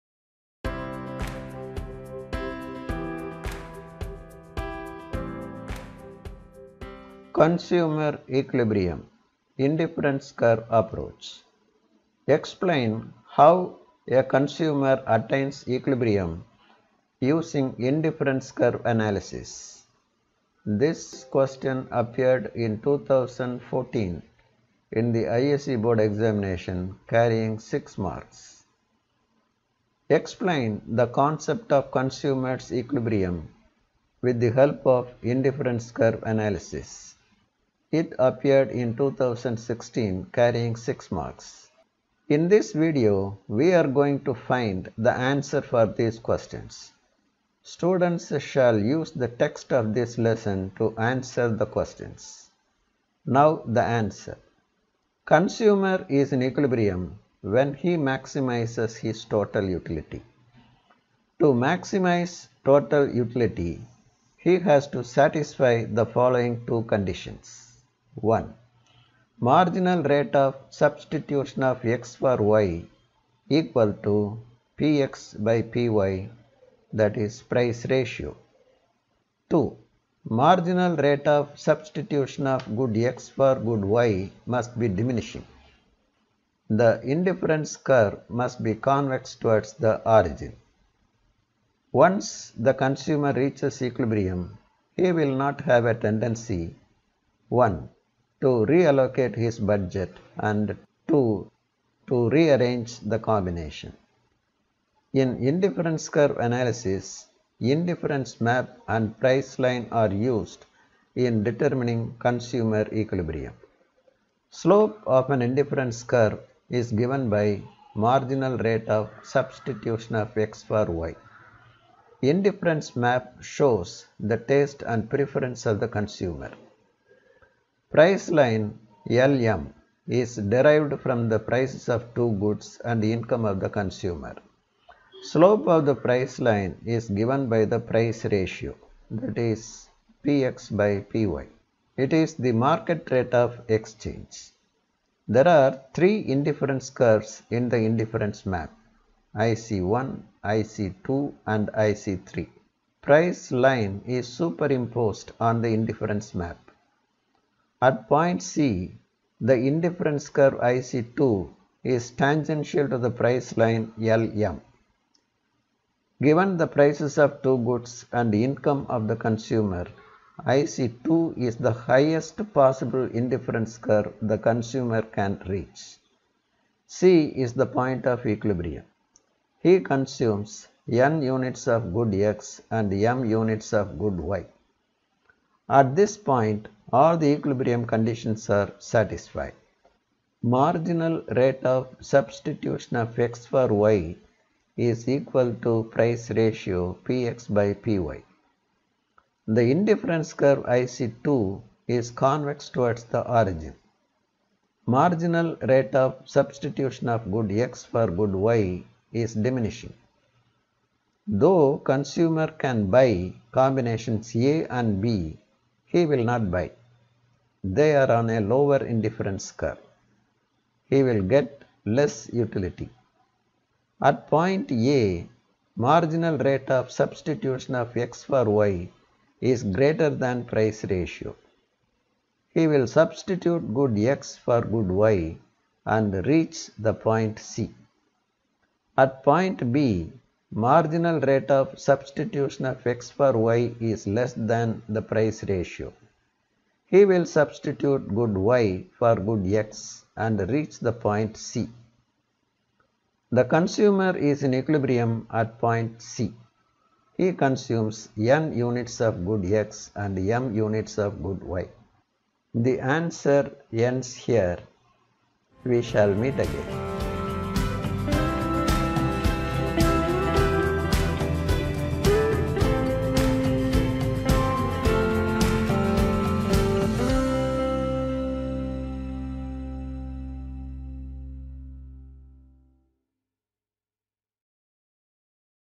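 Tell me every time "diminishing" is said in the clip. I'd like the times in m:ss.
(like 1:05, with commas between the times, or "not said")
1:24, 3:29.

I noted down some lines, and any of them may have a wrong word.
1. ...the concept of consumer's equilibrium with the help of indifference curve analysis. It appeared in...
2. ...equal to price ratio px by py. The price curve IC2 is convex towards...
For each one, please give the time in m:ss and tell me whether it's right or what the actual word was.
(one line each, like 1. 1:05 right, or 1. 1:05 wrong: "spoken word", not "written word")
1. 0:30 right
2. 3:15 wrong: "indifference", not "price".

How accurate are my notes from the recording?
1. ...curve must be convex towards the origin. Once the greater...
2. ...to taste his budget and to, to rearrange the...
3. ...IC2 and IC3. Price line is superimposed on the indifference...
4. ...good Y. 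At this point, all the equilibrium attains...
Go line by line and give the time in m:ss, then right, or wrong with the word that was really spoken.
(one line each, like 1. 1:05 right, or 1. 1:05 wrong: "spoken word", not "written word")
1. 1:27 wrong: "consumer", not "greater"
2. 1:38 wrong: "reallocate", not "taste"
3. 2:30 right
4. 3:03 wrong: "conditions", not "attains".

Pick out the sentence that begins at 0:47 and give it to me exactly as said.
Students shall use the text of this lesson to answer the questions.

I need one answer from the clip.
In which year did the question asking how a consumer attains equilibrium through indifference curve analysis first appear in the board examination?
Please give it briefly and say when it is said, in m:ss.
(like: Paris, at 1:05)
2014, at 0:22.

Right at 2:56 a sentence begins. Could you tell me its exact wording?
C is the point of equilibrium.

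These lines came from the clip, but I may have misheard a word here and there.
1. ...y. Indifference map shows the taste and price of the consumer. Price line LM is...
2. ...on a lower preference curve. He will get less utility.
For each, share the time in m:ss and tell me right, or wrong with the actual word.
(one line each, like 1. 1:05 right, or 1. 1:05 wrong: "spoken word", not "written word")
1. 2:00 wrong: "preference", not "price"
2. 3:38 wrong: "indifference", not "preference".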